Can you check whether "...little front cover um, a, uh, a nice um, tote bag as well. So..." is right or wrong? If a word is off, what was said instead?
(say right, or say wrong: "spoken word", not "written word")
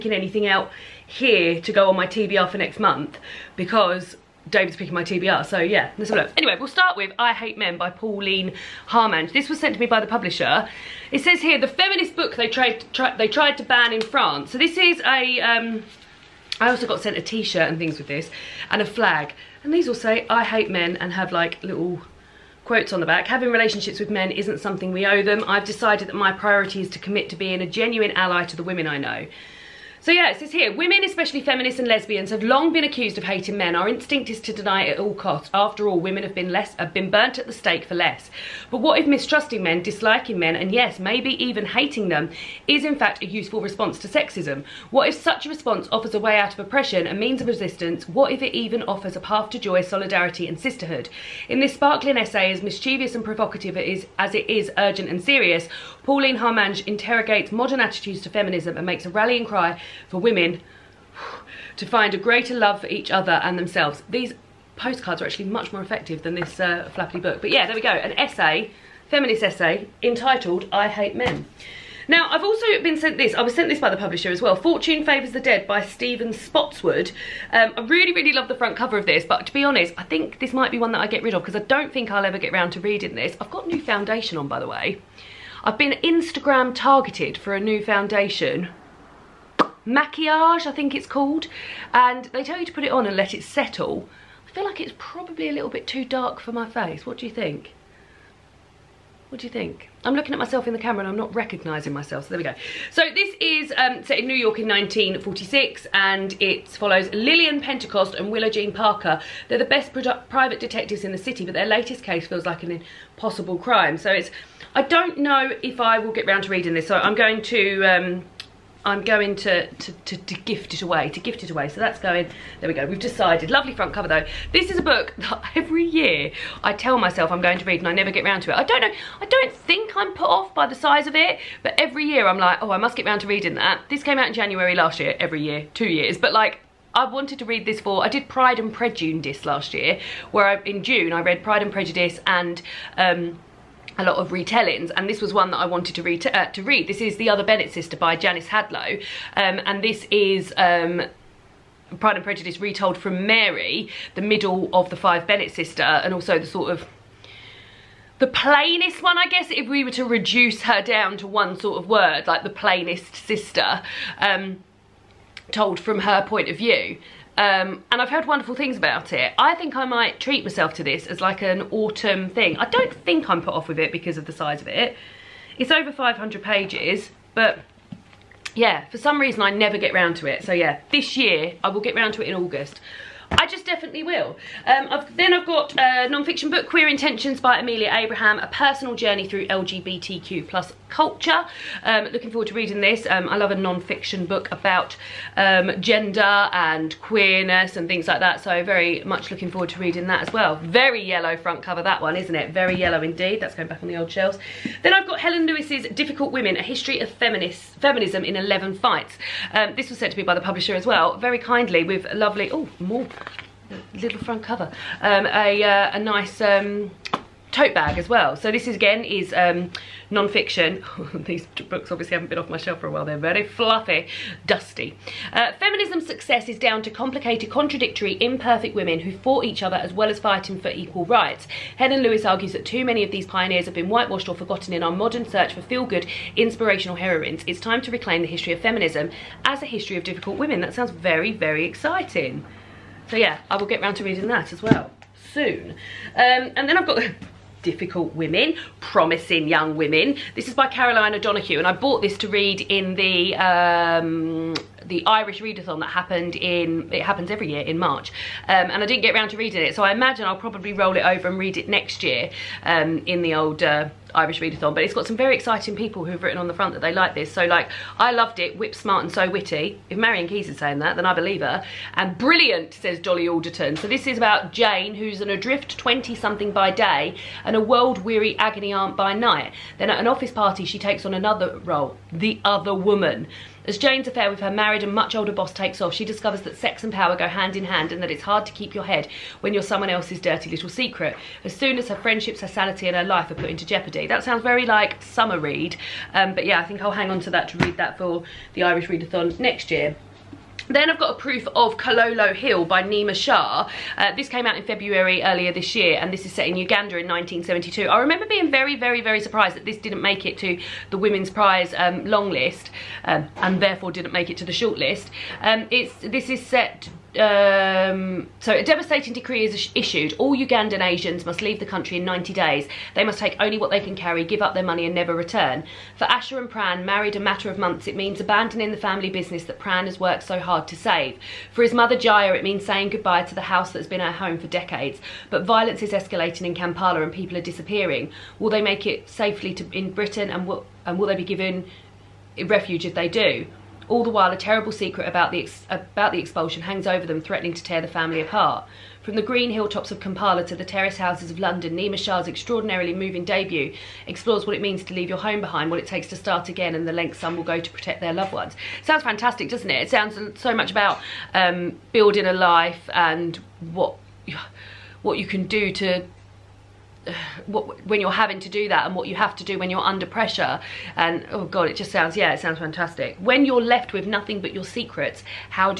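right.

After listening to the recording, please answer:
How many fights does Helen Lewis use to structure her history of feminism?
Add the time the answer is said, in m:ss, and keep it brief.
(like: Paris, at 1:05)
11, at 3:28.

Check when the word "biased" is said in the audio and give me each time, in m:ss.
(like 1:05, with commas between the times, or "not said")
not said.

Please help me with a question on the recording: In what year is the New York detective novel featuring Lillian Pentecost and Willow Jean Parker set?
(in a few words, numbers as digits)
1946.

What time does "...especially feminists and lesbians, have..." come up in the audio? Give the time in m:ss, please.
0:31.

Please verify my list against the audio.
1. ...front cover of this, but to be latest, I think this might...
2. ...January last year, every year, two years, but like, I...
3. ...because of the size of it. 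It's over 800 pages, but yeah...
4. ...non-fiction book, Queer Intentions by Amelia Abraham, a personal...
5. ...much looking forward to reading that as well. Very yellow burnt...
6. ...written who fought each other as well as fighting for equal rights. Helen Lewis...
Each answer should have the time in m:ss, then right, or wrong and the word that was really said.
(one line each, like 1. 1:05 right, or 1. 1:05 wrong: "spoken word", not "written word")
1. 1:18 wrong: "honest", not "latest"
2. 2:14 right
3. 2:53 wrong: "500", not "800"
4. 3:06 right
5. 3:19 wrong: "front", not "burnt"
6. 3:48 wrong: "women", not "written".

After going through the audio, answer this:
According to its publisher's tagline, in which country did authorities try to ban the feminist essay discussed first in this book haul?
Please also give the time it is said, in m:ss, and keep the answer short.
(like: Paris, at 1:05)
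France, at 0:14.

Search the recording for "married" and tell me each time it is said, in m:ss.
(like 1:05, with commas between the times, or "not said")
4:44, 5:26.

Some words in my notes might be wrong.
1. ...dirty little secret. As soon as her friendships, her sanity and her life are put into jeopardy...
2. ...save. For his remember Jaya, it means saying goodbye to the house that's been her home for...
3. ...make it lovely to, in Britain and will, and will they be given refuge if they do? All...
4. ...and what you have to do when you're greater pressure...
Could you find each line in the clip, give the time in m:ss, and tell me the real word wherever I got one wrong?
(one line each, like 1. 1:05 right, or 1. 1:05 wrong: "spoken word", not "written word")
1. 4:50 right
2. 5:30 wrong: "mother", not "remember"
3. 5:38 wrong: "safely", not "lovely"
4. 6:08 wrong: "under", not "greater".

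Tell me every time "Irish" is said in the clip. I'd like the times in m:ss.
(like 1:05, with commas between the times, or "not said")
4:15, 4:24, 4:58.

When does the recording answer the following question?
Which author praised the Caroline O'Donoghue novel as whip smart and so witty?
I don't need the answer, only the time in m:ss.
4:29.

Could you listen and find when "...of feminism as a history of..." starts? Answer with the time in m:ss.
3:58.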